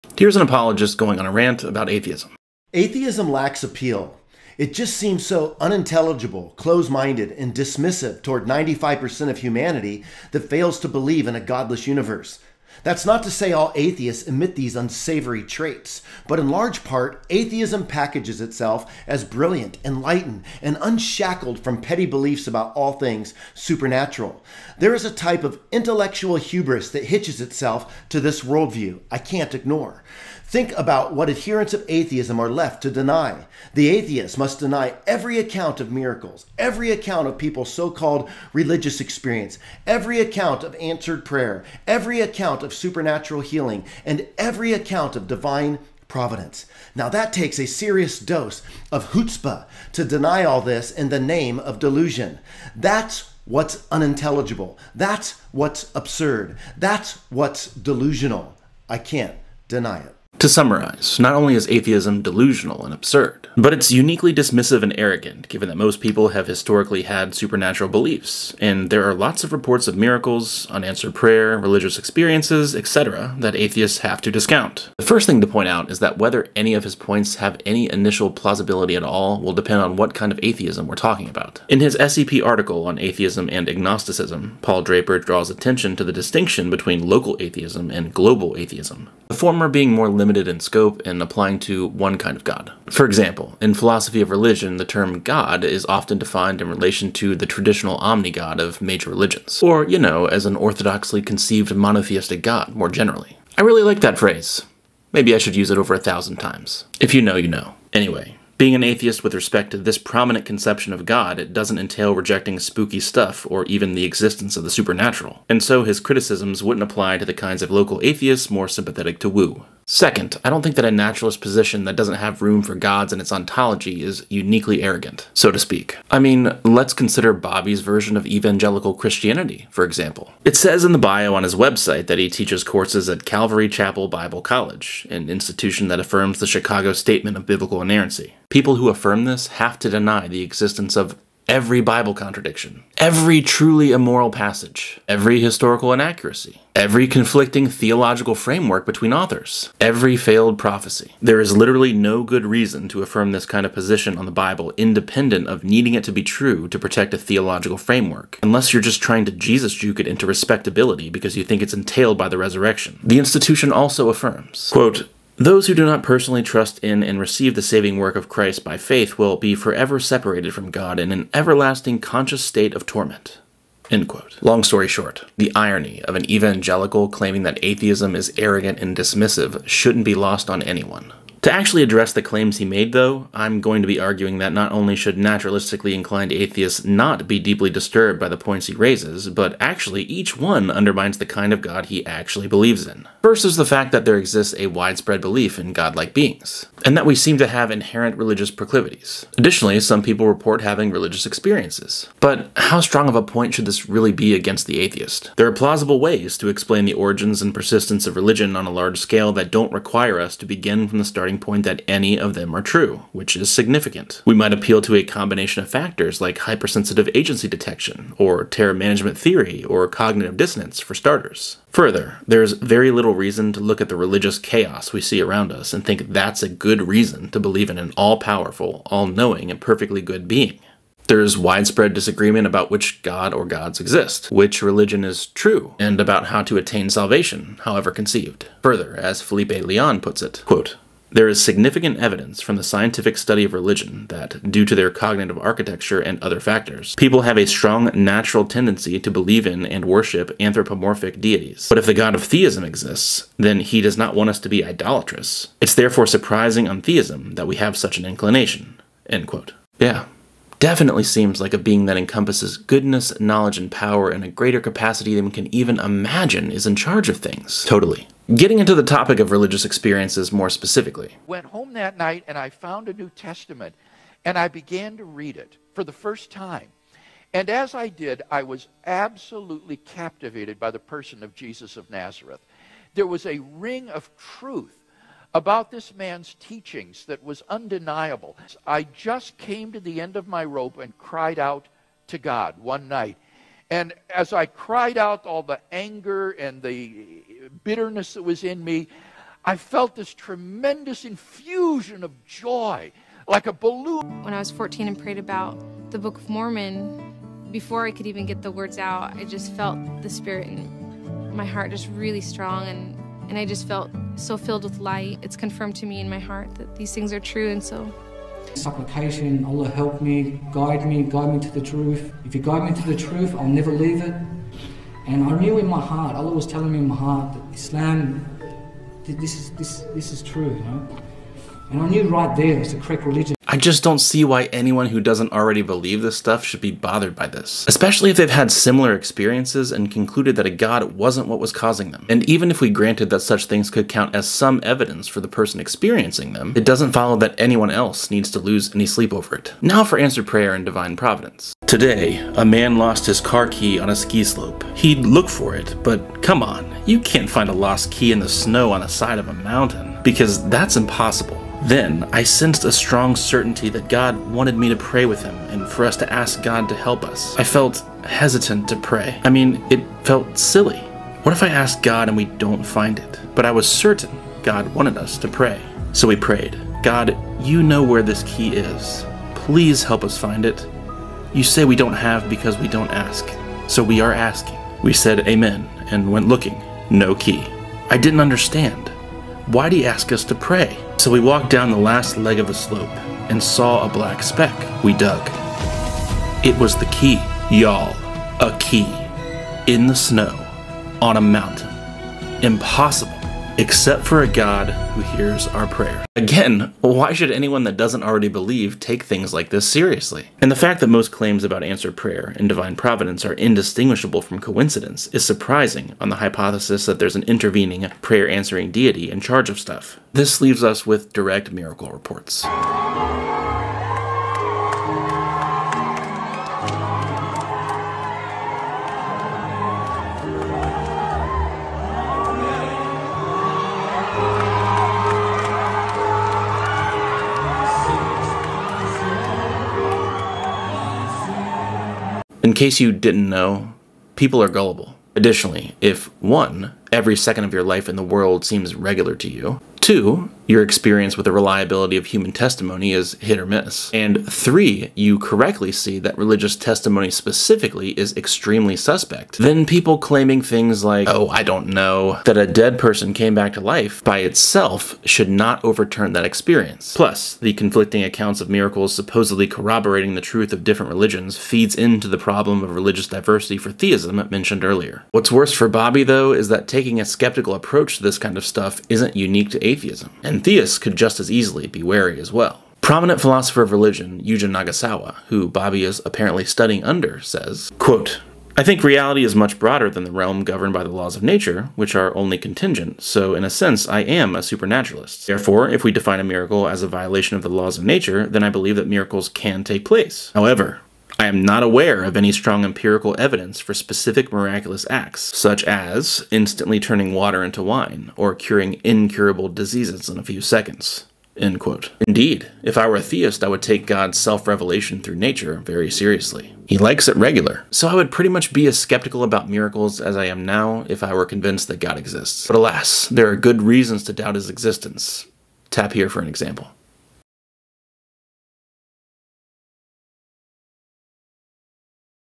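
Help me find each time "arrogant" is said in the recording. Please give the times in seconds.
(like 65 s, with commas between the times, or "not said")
64 s, 124 s, 178 s.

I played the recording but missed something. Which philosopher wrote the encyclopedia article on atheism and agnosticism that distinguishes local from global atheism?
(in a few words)
Paul Draper.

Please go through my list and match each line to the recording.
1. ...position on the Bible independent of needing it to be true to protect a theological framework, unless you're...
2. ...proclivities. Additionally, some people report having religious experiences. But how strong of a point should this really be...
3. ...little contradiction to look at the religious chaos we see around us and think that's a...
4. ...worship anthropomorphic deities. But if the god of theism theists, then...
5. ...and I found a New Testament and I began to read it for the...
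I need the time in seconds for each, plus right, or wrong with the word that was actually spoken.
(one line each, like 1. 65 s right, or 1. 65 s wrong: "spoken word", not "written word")
1. 153 s right
2. 198 s right
3. 222 s wrong: "reason", not "contradiction"
4. 249 s wrong: "exists", not "theists"
5. 272 s right.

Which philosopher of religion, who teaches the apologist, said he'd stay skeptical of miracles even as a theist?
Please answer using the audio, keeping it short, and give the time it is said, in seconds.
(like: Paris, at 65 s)
Yujin Nagasawa, at 484 s.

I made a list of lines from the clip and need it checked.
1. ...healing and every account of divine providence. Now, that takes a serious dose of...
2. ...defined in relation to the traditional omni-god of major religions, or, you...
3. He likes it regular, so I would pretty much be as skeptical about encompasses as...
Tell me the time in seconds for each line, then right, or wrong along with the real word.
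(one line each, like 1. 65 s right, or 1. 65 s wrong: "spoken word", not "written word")
1. 43 s right
2. 96 s right
3. 516 s wrong: "miracles", not "encompasses".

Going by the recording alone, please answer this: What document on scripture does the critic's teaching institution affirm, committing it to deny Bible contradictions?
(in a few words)
Chicago Statement of Biblical Inerrancy.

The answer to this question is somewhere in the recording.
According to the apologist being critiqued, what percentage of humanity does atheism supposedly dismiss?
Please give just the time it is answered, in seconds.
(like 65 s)
8 s.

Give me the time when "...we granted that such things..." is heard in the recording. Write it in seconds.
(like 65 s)
342 s.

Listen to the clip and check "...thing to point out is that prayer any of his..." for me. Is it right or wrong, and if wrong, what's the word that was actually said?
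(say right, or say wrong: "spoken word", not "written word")
wrong: "whether", not "prayer".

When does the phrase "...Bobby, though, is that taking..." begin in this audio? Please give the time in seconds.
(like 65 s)
475 s.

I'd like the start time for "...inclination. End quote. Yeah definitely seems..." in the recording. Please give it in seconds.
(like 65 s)
258 s.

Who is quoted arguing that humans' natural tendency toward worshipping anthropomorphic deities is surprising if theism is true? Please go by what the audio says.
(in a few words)
Felipe Leon.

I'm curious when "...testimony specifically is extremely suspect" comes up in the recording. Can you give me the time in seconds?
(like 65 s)
456 s.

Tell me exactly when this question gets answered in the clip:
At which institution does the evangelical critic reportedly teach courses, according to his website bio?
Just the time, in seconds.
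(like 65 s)
133 s.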